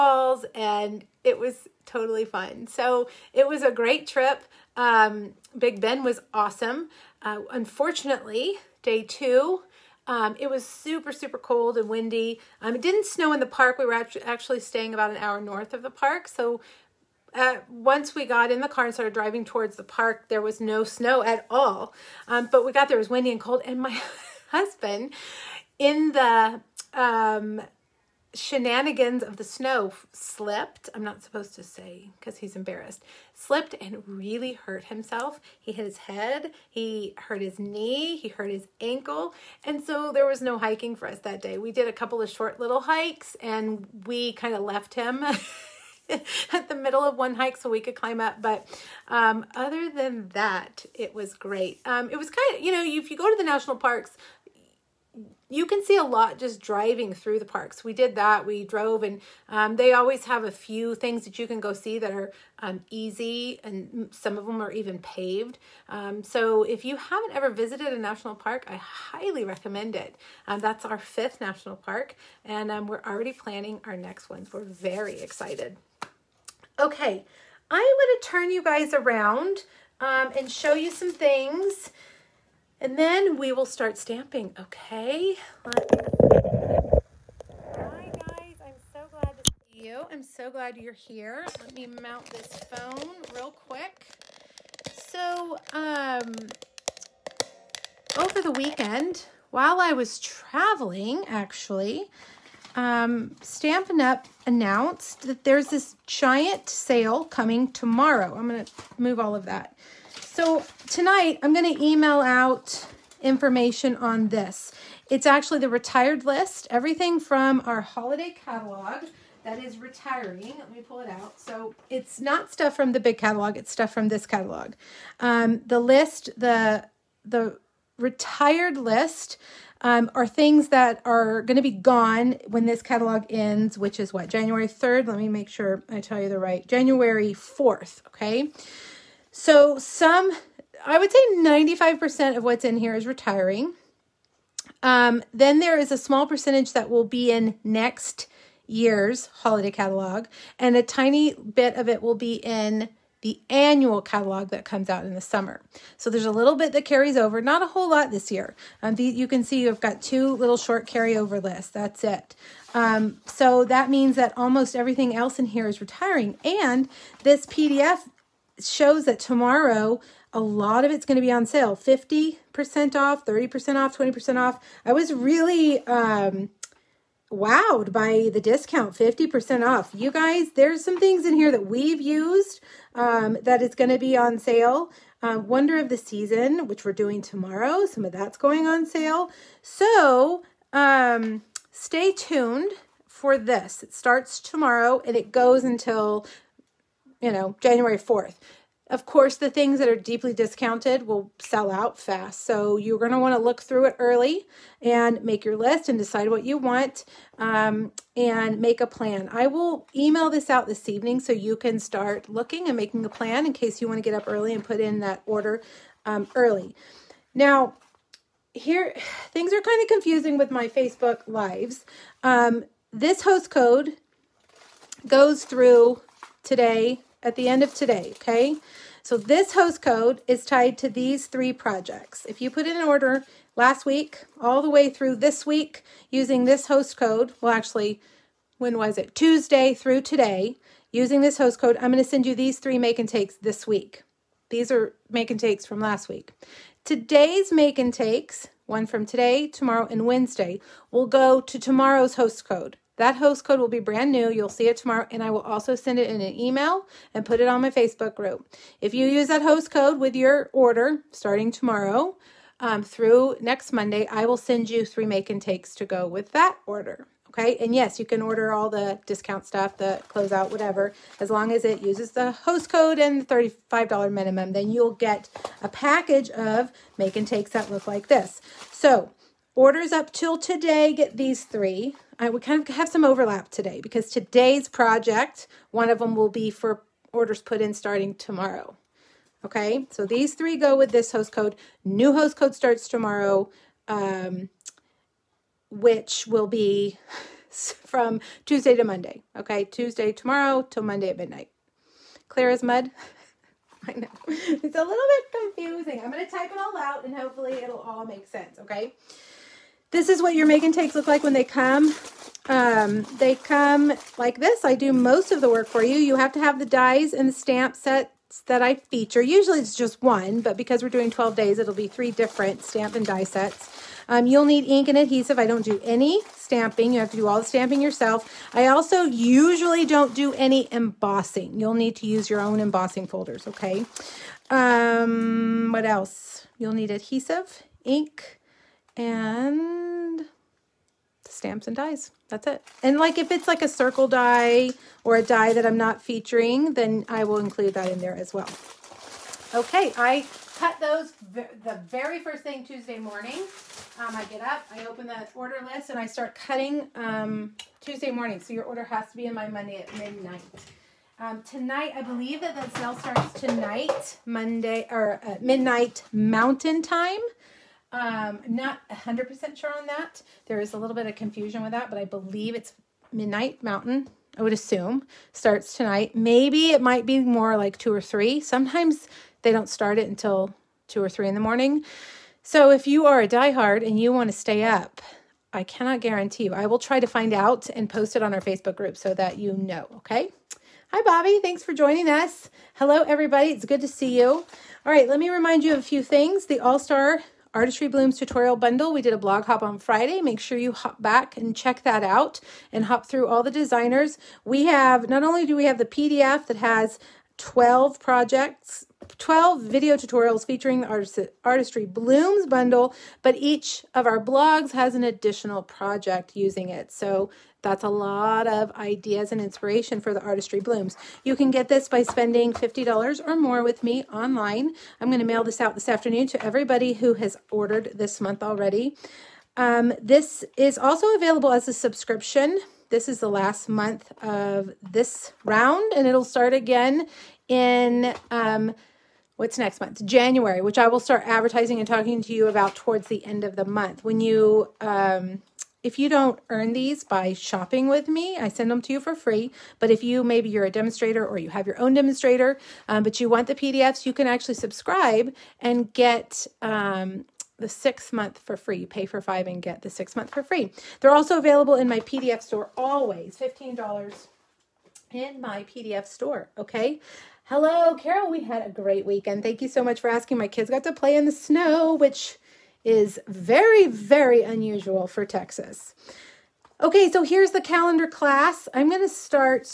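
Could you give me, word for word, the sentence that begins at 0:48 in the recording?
But um, other than that, it was great.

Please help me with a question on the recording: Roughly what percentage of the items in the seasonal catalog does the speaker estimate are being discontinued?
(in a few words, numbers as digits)
95%.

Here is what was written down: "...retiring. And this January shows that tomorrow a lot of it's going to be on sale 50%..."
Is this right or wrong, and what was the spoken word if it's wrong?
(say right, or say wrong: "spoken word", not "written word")
wrong: "PDF", not "January".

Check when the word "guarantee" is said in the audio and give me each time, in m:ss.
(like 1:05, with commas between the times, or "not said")
6:25.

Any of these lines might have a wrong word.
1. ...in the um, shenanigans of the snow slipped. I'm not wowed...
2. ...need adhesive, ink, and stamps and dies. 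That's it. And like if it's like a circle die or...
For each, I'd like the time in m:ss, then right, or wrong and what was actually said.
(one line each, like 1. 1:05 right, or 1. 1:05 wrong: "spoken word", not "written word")
1. 0:25 wrong: "supposed", not "wowed"
2. 5:36 right.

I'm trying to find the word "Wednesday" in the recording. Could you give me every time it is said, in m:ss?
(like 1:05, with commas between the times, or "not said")
4:10.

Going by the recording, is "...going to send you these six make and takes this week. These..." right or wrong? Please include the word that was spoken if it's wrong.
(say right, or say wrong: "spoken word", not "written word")
wrong: "three", not "six".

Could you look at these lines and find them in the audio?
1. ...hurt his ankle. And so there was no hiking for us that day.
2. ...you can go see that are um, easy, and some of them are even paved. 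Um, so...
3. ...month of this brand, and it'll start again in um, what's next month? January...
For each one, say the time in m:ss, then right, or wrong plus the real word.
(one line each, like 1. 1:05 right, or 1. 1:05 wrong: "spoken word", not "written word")
1. 0:38 right
2. 1:01 right
3. 7:13 wrong: "round", not "brand".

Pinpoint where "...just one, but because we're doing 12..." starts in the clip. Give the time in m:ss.
5:19.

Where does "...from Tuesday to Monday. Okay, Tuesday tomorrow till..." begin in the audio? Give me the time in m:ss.
4:57.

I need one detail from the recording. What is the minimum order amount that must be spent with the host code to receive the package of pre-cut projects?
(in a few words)
$35.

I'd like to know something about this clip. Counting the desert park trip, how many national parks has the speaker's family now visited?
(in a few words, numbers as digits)
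5th.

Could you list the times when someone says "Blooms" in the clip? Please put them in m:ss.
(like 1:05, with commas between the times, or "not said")
6:37, 6:51, 7:00.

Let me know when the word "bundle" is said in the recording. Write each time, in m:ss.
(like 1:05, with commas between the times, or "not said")
6:38, 6:52.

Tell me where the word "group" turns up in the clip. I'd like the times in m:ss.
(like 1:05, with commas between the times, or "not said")
4:18, 6:28.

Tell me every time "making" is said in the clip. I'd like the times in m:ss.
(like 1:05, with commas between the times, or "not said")
3:32.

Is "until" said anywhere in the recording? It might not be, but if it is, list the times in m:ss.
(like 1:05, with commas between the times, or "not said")
3:15, 6:20.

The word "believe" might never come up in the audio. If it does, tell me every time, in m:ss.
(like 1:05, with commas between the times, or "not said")
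6:02, 6:12.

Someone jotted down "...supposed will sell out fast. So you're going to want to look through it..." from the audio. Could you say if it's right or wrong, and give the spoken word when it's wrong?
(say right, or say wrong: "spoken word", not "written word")
wrong: "discounted", not "supposed".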